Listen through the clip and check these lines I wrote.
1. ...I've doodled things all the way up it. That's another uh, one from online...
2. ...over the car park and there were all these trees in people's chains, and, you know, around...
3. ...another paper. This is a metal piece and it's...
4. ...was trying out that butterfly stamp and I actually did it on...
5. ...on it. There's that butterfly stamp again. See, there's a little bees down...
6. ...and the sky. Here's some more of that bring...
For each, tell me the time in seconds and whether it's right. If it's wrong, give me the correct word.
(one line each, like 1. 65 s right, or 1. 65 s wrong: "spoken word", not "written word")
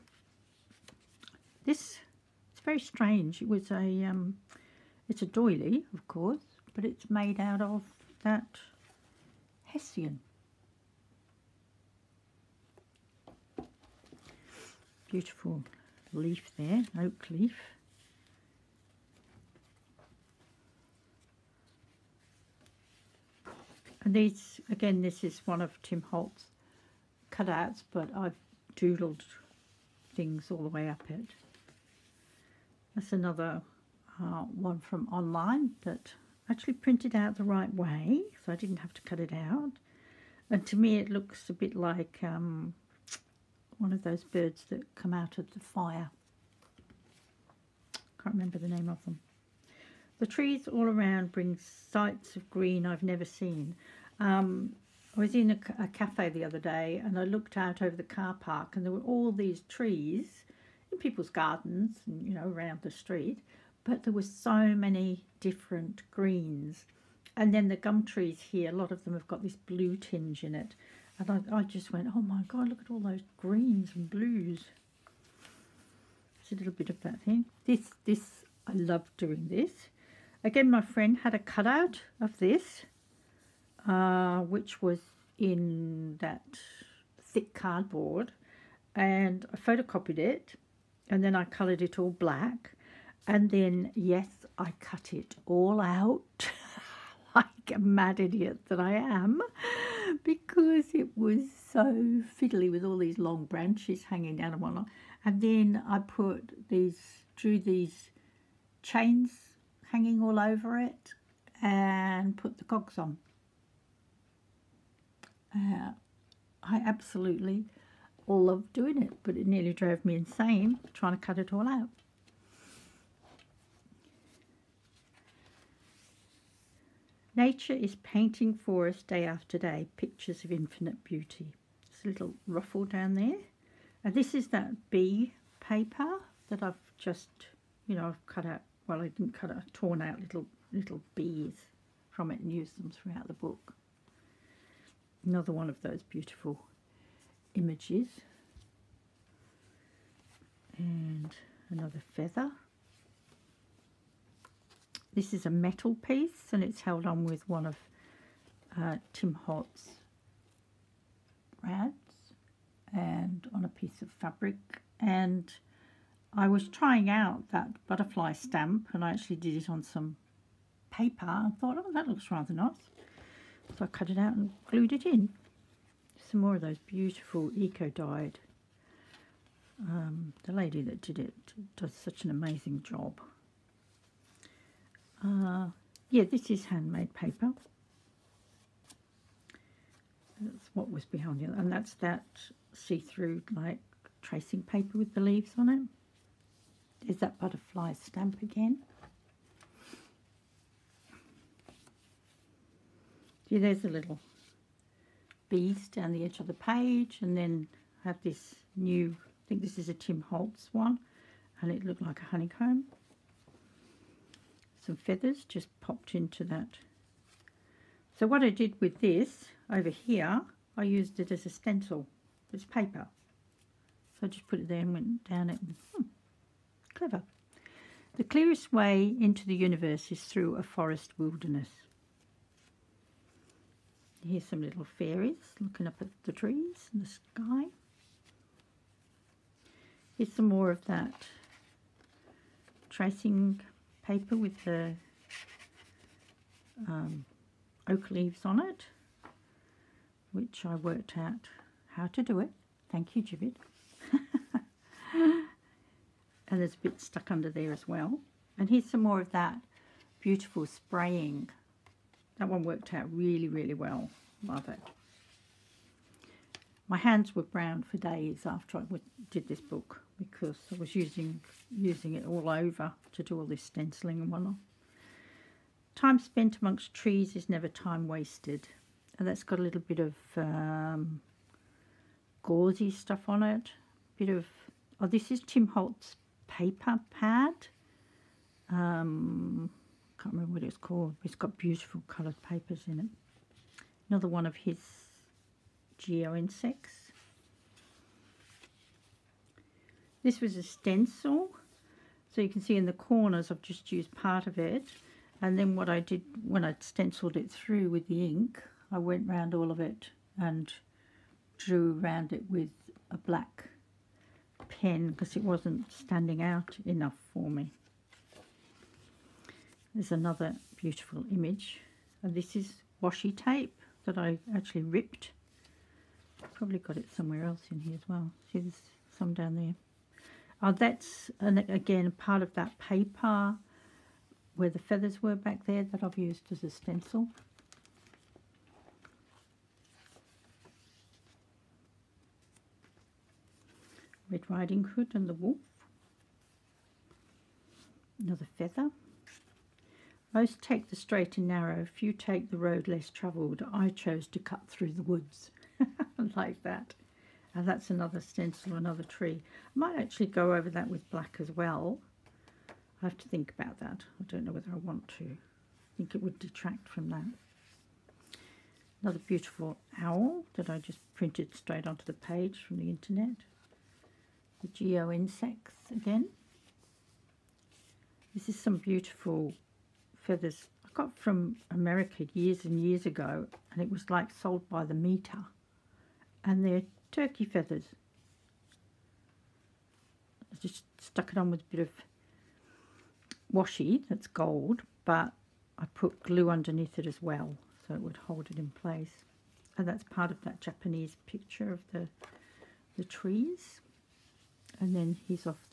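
1. 28 s right
2. 57 s wrong: "gardens", not "chains"
3. 151 s wrong: "feather", not "paper"
4. 166 s right
5. 195 s right
6. 236 s wrong: "tracing", not "bring".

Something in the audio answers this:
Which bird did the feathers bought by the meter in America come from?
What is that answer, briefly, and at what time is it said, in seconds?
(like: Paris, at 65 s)
turkey, at 387 s.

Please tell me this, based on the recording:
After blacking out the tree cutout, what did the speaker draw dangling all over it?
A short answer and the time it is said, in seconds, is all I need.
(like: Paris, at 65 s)
chains, at 108 s.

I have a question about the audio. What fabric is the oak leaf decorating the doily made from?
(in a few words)
hessian.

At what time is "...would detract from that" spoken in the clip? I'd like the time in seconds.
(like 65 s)
366 s.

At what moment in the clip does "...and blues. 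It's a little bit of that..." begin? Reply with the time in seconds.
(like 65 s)
73 s.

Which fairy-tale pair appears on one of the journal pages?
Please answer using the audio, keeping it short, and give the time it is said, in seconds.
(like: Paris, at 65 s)
Red Riding Hood and the Wolf, at 344 s.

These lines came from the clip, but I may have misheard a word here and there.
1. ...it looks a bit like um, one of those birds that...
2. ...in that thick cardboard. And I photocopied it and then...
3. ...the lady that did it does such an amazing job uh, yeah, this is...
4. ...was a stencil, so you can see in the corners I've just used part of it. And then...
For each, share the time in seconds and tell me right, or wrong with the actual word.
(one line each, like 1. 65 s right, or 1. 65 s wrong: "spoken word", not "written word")
1. 40 s right
2. 85 s right
3. 180 s right
4. 300 s right.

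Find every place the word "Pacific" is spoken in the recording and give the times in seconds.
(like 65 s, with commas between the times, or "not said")
not said.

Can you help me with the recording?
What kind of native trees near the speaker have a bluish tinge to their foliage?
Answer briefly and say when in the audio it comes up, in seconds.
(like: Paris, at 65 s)
gum trees, at 67 s.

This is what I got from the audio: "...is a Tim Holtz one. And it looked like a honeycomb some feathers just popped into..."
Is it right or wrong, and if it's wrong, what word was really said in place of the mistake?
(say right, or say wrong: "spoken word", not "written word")
right.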